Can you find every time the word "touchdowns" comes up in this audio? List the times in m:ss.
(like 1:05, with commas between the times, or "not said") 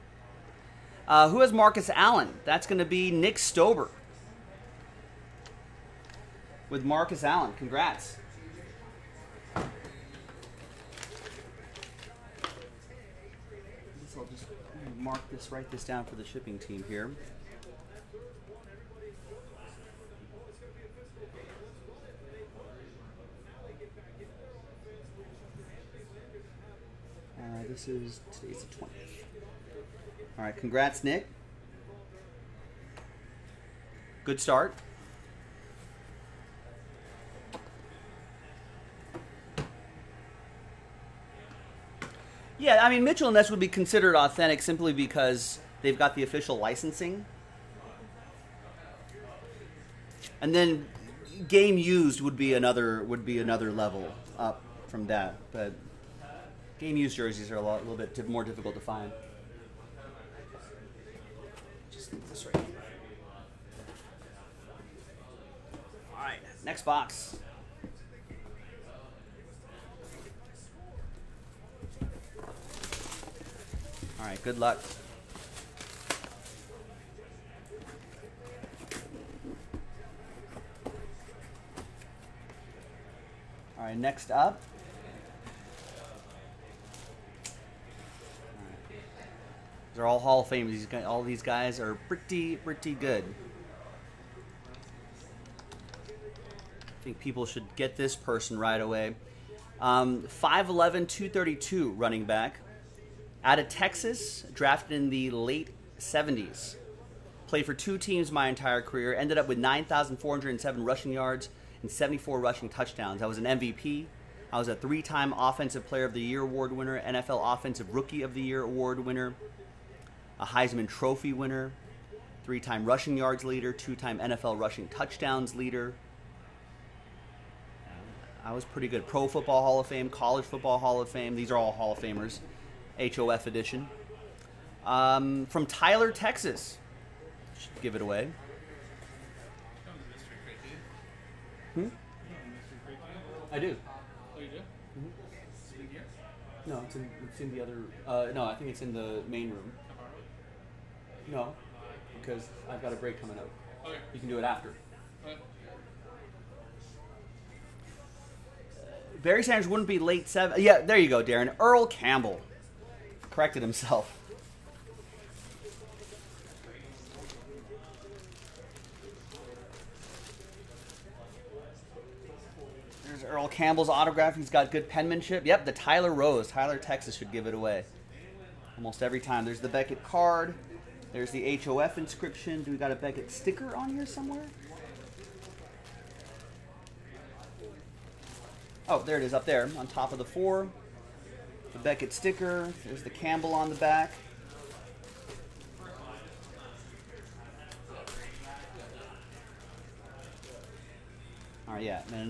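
1:52, 2:04.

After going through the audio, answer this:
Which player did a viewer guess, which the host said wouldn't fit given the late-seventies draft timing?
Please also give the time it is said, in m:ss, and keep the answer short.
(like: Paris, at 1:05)
Barry Sanders, at 2:39.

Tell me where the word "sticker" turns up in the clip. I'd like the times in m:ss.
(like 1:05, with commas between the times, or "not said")
3:03, 3:12.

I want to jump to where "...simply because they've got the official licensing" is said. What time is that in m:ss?
0:44.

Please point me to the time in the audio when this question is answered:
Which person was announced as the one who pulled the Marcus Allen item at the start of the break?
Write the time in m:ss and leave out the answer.
0:03.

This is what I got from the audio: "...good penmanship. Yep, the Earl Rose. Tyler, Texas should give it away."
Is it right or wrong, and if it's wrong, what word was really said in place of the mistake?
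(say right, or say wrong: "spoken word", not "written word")
wrong: "Tyler", not "Earl".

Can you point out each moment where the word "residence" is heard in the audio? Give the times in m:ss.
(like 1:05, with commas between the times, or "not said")
not said.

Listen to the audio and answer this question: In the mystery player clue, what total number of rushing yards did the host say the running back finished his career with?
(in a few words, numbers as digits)
9,407.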